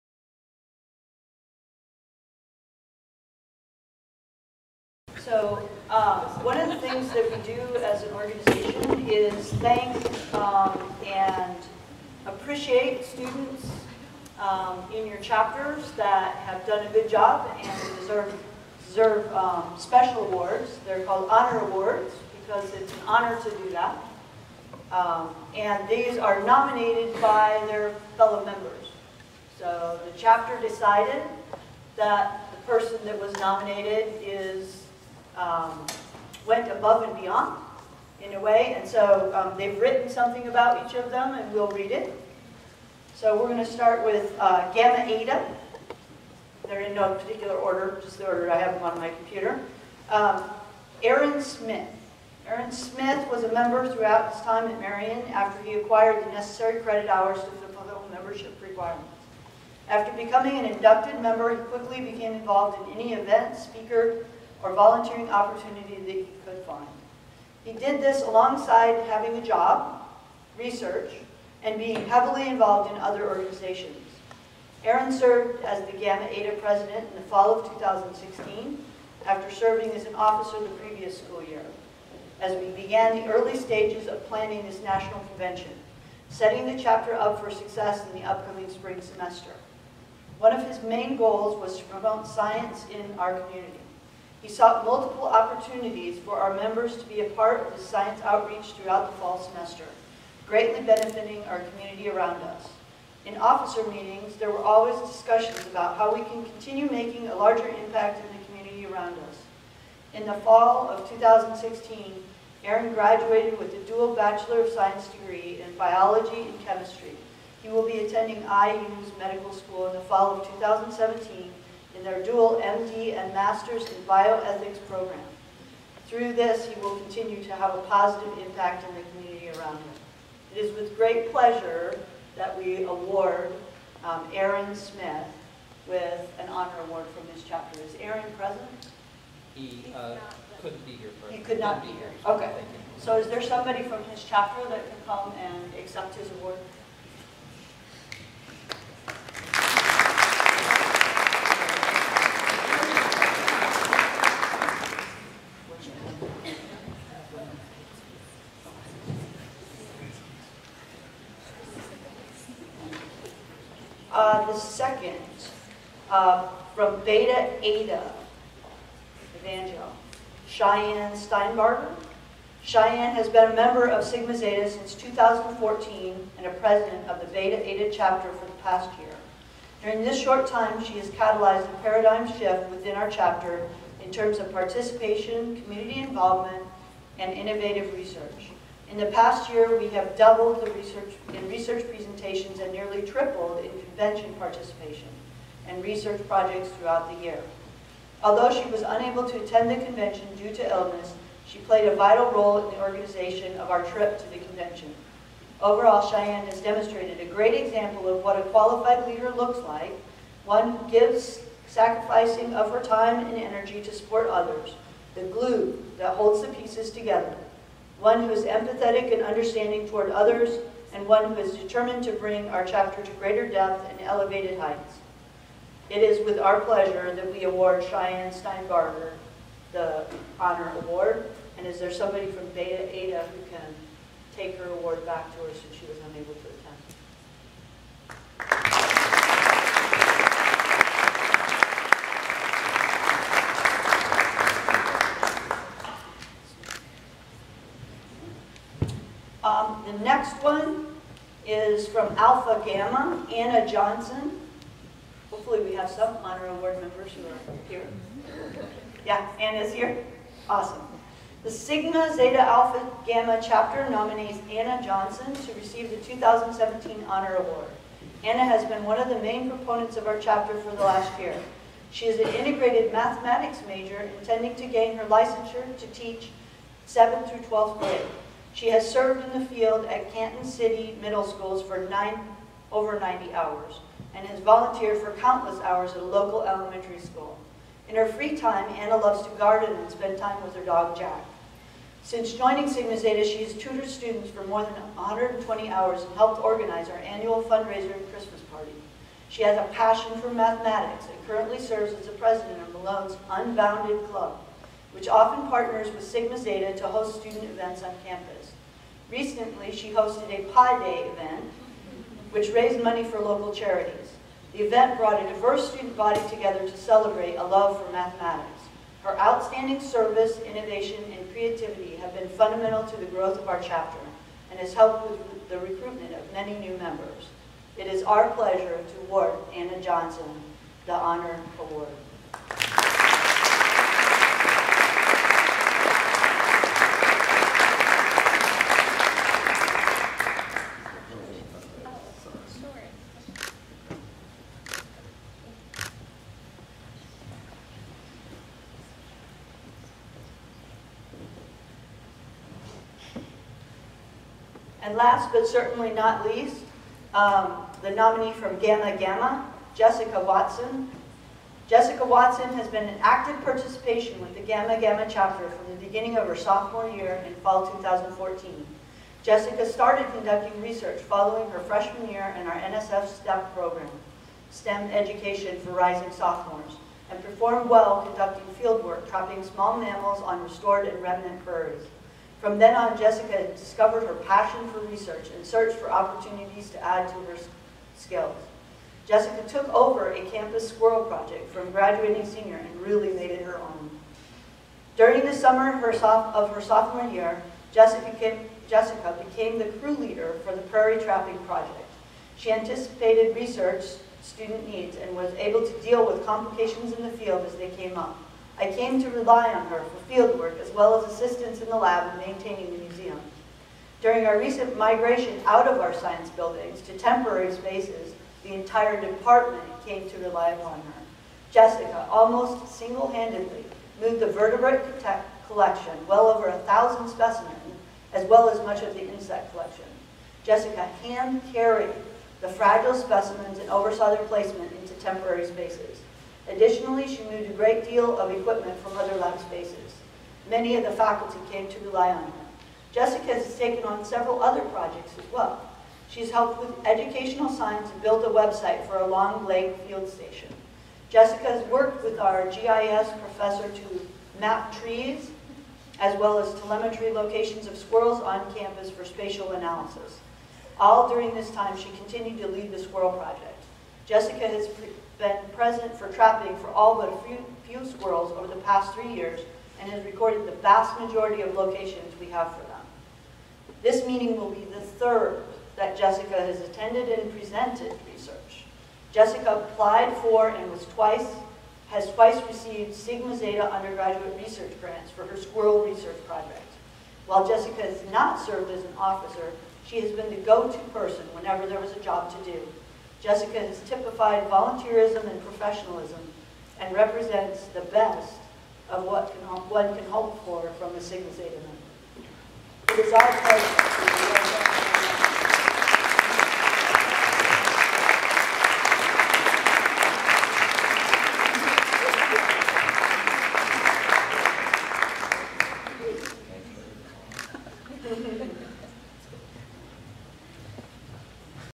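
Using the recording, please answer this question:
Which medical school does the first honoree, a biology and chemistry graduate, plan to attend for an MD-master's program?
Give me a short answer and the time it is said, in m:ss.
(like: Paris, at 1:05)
IU, at 1:58.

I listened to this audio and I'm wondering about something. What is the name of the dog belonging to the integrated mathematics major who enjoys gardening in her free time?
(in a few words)
Jack.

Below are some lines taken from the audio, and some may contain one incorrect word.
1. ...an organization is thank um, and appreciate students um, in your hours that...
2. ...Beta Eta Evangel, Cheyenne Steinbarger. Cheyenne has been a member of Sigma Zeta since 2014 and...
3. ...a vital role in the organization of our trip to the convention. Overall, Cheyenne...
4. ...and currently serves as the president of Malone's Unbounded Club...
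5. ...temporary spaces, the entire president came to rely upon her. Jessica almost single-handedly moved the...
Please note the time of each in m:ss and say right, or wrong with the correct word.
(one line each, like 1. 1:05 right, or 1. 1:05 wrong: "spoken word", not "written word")
1. 0:08 wrong: "chapters", not "hours"
2. 2:47 right
3. 3:21 right
4. 5:01 right
5. 6:56 wrong: "department", not "president".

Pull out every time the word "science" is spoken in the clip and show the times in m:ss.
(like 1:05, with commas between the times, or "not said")
1:32, 1:37, 1:54, 6:55, 7:27.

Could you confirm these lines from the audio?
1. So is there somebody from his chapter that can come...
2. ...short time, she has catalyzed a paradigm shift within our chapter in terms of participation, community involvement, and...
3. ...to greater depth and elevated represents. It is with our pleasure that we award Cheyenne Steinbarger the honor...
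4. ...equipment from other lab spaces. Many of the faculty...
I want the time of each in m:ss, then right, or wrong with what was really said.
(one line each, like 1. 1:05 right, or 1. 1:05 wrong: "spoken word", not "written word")
1. 2:22 right
2. 3:00 right
3. 3:43 wrong: "heights", not "represents"
4. 7:18 right.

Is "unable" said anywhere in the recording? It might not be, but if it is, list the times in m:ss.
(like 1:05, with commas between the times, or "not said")
3:18, 3:56.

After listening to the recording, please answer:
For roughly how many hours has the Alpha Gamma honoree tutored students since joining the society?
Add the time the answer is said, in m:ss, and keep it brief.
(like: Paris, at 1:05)
120, at 4:54.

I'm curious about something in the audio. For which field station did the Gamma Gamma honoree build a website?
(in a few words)
Long Lake.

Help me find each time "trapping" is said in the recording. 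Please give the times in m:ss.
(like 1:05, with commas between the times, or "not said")
6:19, 6:41, 7:46.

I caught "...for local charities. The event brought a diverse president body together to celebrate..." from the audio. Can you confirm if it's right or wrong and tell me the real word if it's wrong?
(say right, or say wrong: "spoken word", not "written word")
wrong: "student", not "president".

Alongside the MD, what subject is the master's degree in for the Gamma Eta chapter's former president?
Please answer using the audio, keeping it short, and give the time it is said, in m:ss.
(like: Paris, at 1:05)
Bioethics, at 2:03.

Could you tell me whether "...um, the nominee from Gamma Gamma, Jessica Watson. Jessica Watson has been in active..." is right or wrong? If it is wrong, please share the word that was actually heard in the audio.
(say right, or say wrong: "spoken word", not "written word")
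right.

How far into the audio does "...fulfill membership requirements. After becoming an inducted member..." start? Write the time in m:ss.
0:57.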